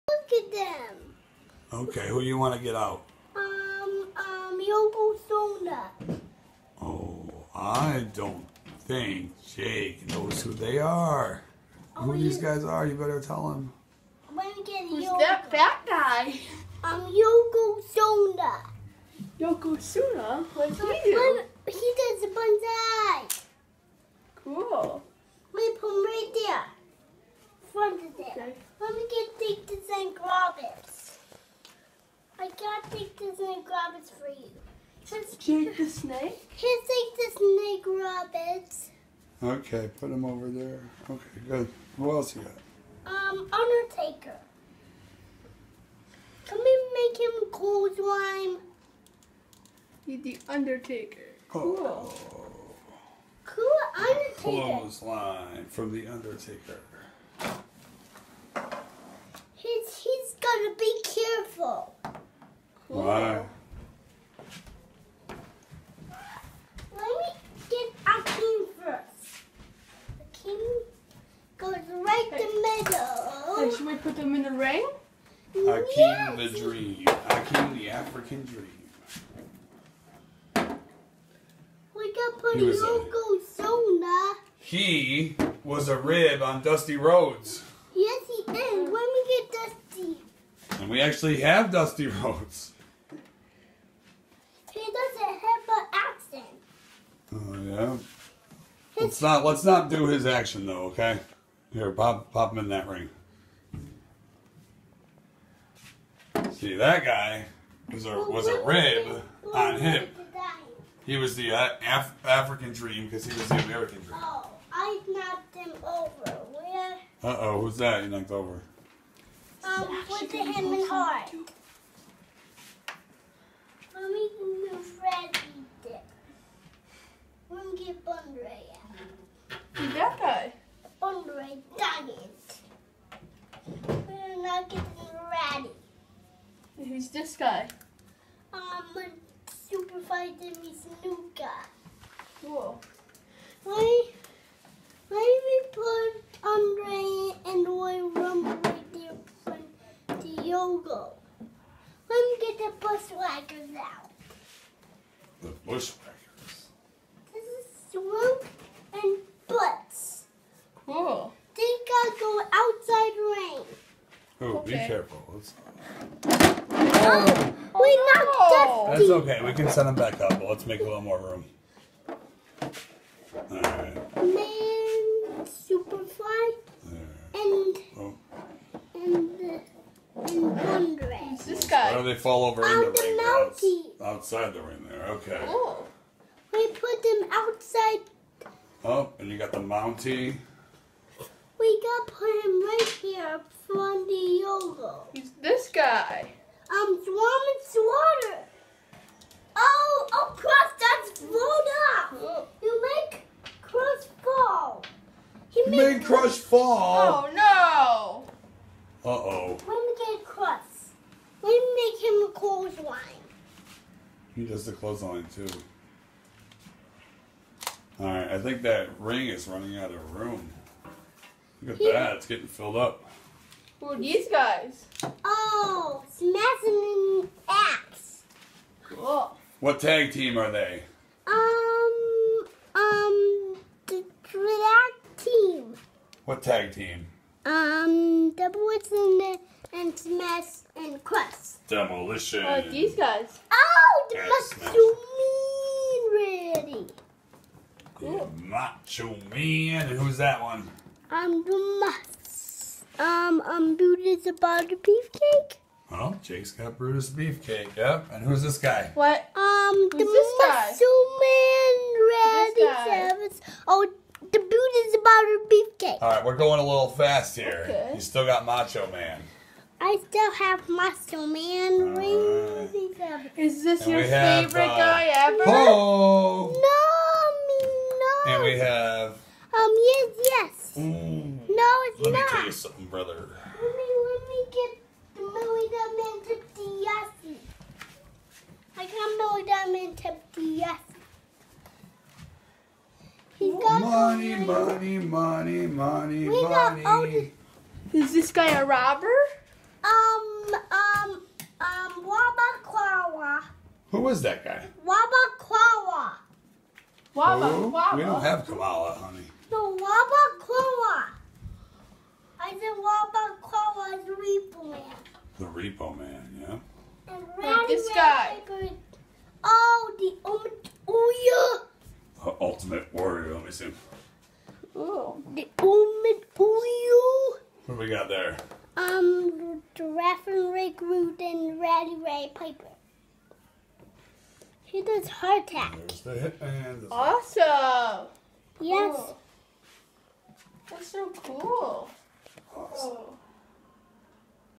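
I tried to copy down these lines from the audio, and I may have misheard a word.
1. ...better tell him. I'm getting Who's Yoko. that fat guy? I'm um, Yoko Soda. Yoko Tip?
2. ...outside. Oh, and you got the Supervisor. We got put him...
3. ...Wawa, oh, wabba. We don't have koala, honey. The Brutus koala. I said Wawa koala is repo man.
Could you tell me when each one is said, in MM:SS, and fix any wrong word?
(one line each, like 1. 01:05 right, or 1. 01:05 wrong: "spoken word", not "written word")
1. 00:12 wrong: "Soda", not "Tip"
2. 03:07 wrong: "Mountie", not "Supervisor"
3. 05:07 wrong: "Wawa", not "Brutus".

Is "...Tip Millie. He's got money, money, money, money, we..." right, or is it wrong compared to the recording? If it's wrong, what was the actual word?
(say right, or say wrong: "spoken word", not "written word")
wrong: "Diassi", not "Millie".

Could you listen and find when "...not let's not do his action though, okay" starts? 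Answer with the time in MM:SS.
01:39.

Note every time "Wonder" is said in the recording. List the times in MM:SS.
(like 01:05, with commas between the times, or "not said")
03:00.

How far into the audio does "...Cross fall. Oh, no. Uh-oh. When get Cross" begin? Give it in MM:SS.
03:26.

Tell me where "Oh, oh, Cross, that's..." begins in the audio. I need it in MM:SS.
03:19.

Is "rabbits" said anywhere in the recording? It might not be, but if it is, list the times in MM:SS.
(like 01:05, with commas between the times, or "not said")
00:33, 00:38.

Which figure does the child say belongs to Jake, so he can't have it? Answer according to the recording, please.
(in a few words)
Brutus the Beefcake.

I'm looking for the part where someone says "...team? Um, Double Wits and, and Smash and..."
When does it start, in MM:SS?
03:56.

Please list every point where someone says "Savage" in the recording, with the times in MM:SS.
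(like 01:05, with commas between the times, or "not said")
04:22, 04:32.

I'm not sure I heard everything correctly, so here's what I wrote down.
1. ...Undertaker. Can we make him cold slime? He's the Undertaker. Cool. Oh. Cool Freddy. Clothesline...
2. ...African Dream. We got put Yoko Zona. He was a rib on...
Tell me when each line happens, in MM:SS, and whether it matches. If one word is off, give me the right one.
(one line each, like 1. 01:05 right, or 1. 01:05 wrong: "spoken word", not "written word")
1. 00:43 wrong: "Undertaker", not "Freddy"
2. 01:17 right.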